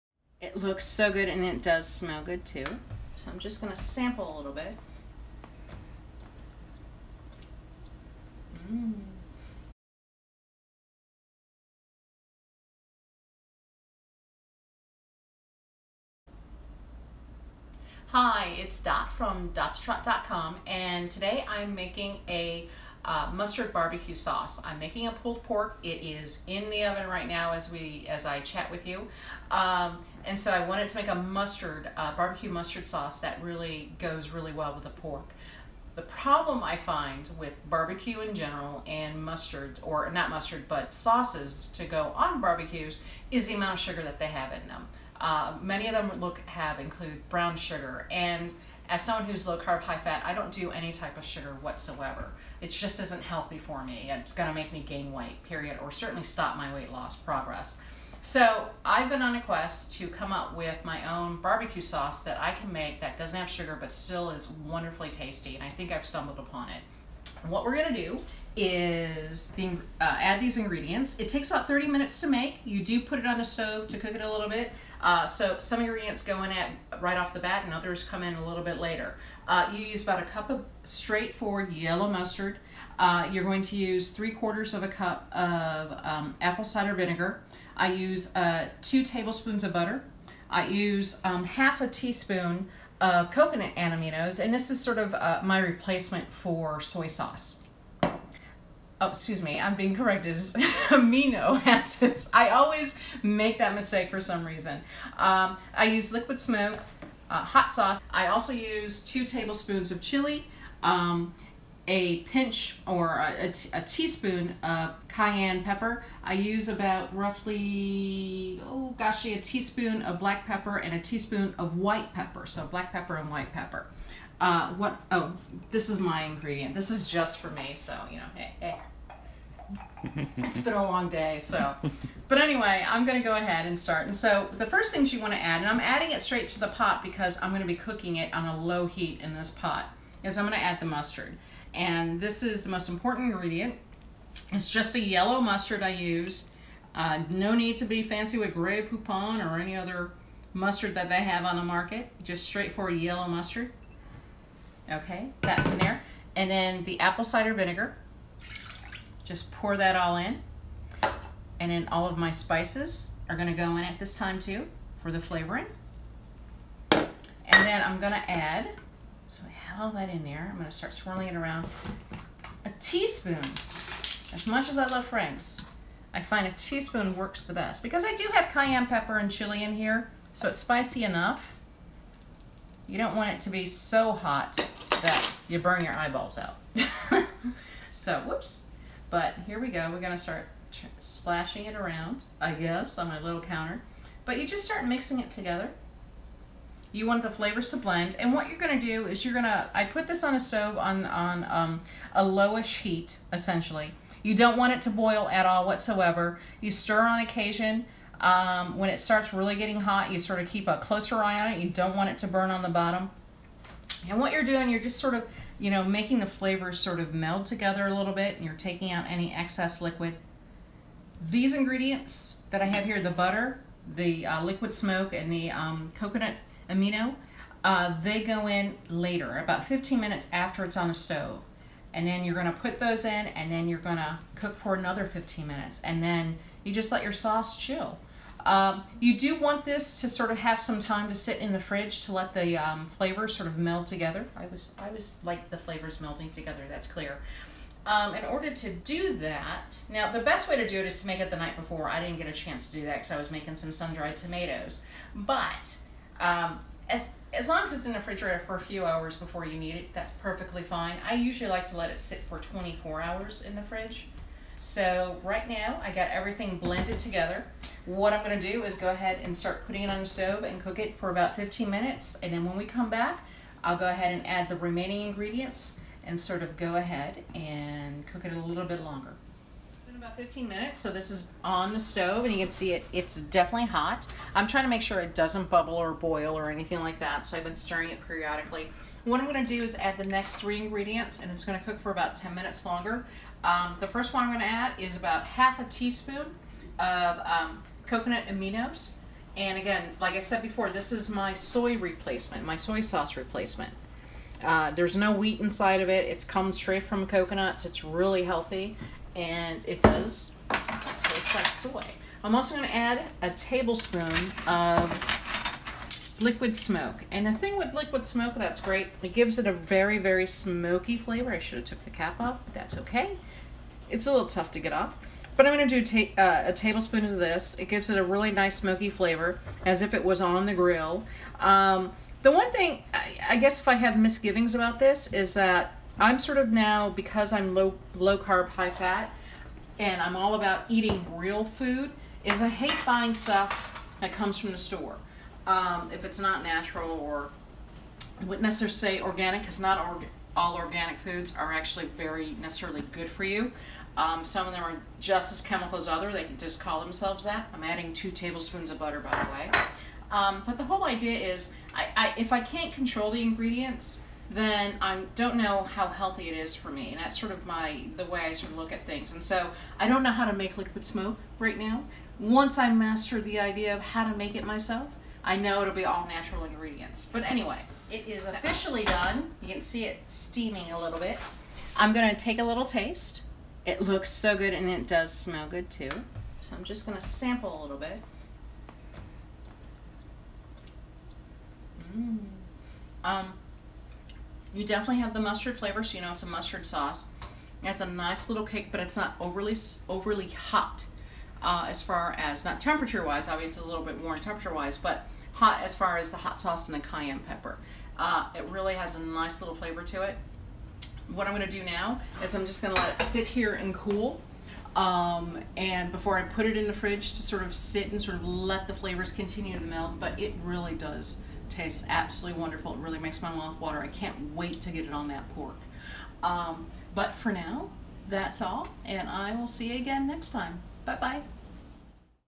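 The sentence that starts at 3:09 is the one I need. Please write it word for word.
We're gonna start splashing it around, I guess, on my little counter.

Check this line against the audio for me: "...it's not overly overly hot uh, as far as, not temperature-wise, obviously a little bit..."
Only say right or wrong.
right.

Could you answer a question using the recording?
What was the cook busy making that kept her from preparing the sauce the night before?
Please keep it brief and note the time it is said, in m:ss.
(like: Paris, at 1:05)
sun-dried tomatoes, at 4:13.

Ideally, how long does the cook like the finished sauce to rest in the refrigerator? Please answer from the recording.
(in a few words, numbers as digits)
24 hours.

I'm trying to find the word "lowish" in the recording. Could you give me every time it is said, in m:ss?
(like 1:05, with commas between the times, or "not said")
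3:22.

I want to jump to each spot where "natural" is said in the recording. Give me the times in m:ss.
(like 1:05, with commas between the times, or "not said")
5:46, 6:16.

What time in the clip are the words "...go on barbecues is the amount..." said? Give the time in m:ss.
0:41.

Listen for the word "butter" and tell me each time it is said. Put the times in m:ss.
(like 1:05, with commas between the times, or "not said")
1:29, 3:43, 5:58.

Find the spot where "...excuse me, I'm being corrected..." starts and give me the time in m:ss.
1:39.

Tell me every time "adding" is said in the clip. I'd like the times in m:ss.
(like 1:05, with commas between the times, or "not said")
2:15, 5:57.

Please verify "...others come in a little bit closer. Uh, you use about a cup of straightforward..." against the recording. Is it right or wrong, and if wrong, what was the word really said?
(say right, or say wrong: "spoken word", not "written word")
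wrong: "later", not "closer".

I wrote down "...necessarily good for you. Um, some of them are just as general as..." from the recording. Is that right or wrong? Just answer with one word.
wrong.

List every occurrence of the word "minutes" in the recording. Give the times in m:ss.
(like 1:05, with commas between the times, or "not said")
1:11, 3:49, 3:55, 4:31, 4:40, 4:52.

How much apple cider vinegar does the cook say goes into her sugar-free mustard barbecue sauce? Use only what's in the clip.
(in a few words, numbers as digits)
3/4 cup.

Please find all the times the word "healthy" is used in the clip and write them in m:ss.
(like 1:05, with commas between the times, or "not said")
0:53, 5:08, 6:05.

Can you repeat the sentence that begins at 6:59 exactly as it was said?
but it really does tastes absolutely wonderful.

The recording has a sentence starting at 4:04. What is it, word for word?
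I was, I was like the flavors melding together, that's clear.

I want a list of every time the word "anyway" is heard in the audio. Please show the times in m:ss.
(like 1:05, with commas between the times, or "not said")
2:12, 6:17.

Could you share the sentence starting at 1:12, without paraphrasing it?
You do put it on the stove to cook it a little bit.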